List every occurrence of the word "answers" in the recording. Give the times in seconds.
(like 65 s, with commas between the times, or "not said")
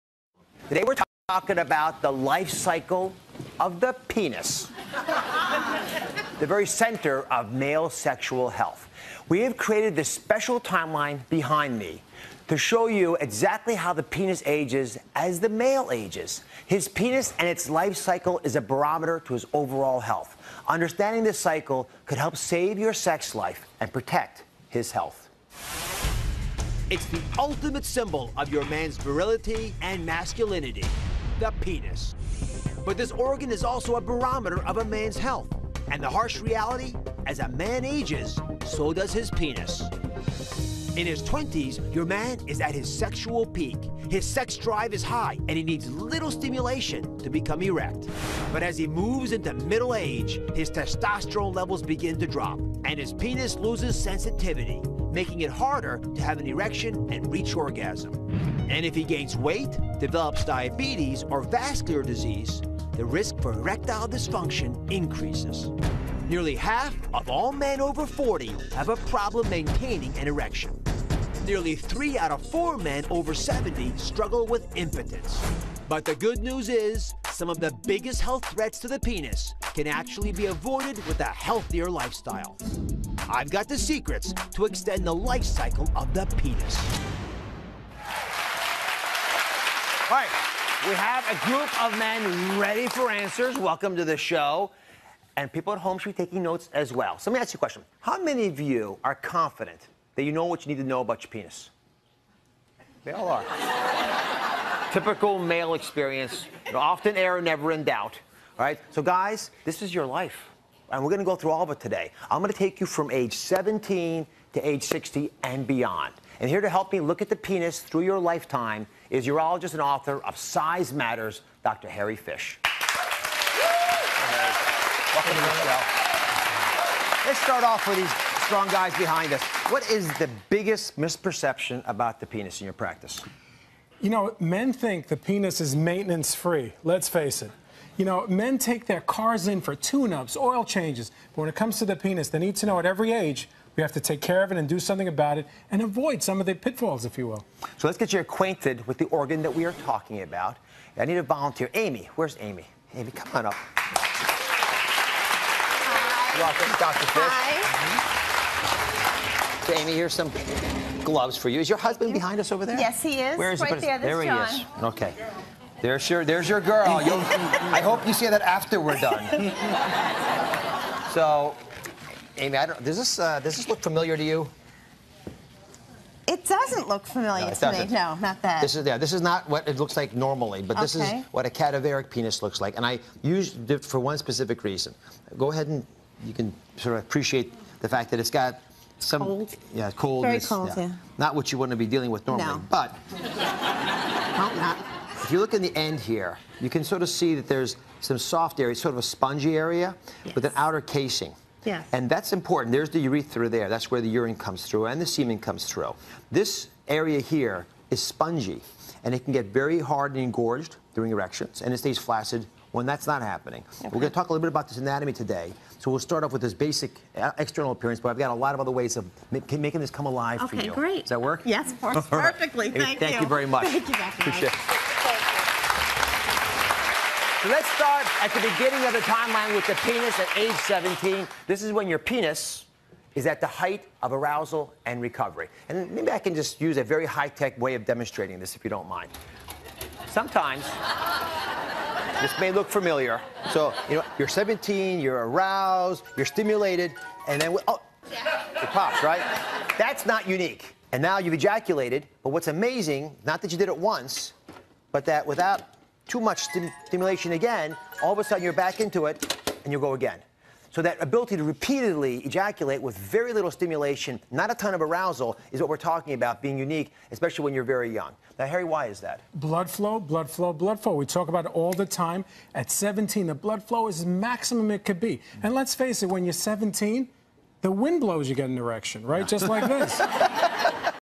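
93 s.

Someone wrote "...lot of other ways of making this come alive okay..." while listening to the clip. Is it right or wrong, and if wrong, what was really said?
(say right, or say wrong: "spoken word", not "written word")
right.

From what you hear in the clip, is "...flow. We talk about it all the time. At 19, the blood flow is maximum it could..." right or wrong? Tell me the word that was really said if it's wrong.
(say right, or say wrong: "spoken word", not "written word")
wrong: "17", not "19".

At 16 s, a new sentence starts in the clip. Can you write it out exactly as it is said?
His penis and its life cycle is a barometer to his overall health.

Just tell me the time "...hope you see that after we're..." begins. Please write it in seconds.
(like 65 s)
167 s.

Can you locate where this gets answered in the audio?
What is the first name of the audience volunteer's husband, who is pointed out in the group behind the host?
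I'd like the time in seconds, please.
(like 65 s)
164 s.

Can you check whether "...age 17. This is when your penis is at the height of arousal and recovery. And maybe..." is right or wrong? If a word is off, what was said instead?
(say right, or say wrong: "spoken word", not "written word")
right.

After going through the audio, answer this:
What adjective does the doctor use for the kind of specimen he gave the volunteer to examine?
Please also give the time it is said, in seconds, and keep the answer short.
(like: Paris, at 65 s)
Cadaveric, at 181 s.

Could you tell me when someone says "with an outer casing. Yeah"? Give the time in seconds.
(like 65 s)
200 s.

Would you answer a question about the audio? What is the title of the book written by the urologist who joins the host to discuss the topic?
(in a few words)
Size Matters.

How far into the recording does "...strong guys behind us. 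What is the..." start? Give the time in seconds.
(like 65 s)
128 s.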